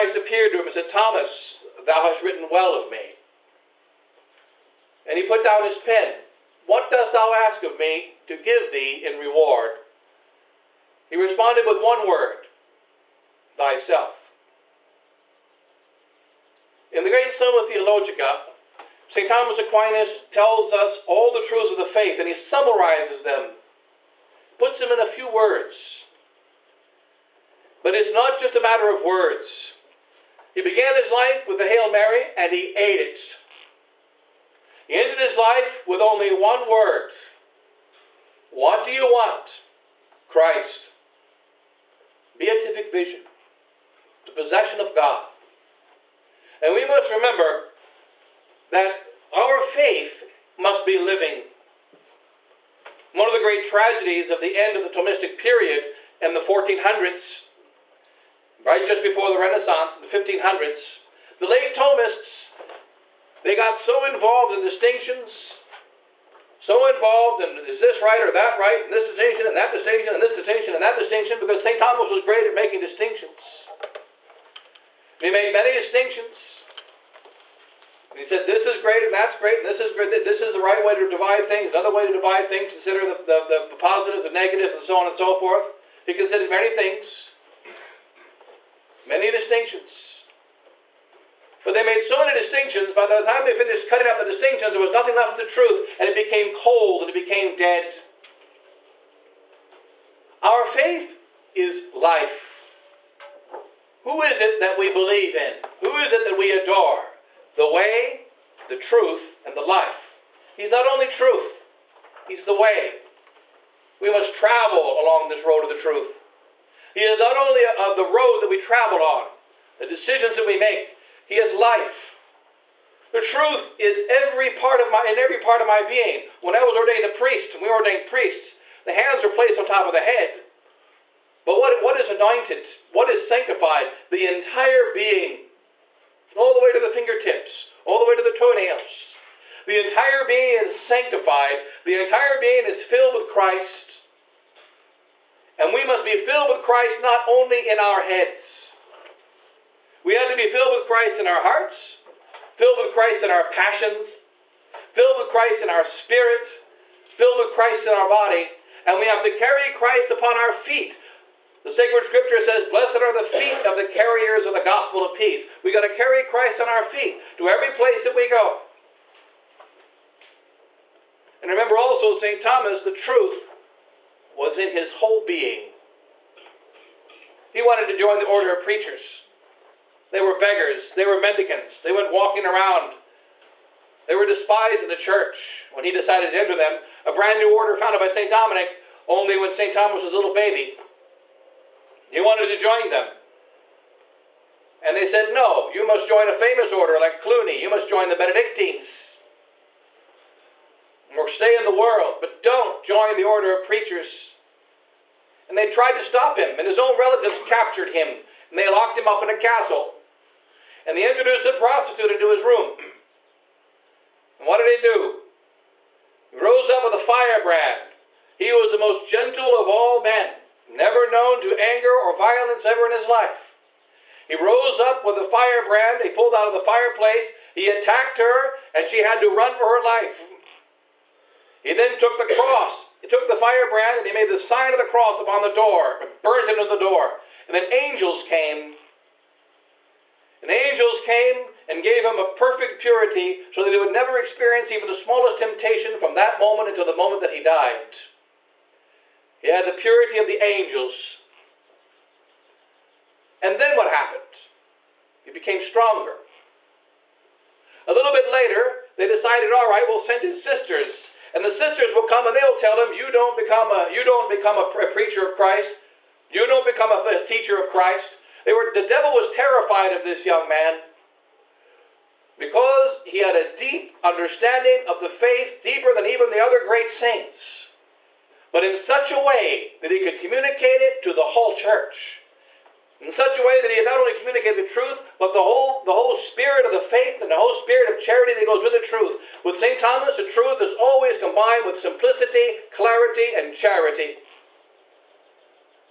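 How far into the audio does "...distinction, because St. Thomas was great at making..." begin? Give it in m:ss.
1:10.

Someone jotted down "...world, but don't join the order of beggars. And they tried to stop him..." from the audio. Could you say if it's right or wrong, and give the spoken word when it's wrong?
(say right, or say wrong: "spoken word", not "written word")
wrong: "preachers", not "beggars".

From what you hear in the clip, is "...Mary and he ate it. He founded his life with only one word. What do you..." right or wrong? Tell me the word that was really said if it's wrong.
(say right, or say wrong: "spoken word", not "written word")
wrong: "ended", not "founded".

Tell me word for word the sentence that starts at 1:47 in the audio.
The way, the truth, and the life.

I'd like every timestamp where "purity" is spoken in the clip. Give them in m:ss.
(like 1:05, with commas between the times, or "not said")
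4:02, 4:09.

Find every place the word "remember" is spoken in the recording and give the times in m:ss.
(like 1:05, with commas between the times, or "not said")
0:47, 2:51.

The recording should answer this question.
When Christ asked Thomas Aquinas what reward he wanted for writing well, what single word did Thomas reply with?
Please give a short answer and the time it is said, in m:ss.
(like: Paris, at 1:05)
Thyself, at 0:13.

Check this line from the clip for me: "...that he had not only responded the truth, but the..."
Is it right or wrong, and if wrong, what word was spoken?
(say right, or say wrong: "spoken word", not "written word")
wrong: "communicated", not "responded".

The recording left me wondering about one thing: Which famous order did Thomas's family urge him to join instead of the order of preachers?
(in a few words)
Cluny.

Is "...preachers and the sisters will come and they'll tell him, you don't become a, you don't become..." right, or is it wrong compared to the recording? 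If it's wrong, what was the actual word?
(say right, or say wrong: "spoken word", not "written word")
wrong: "sisters", not "preachers".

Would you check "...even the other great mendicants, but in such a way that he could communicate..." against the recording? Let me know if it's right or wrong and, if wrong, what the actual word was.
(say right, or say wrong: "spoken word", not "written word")
wrong: "saints", not "mendicants".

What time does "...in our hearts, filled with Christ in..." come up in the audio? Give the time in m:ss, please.
2:31.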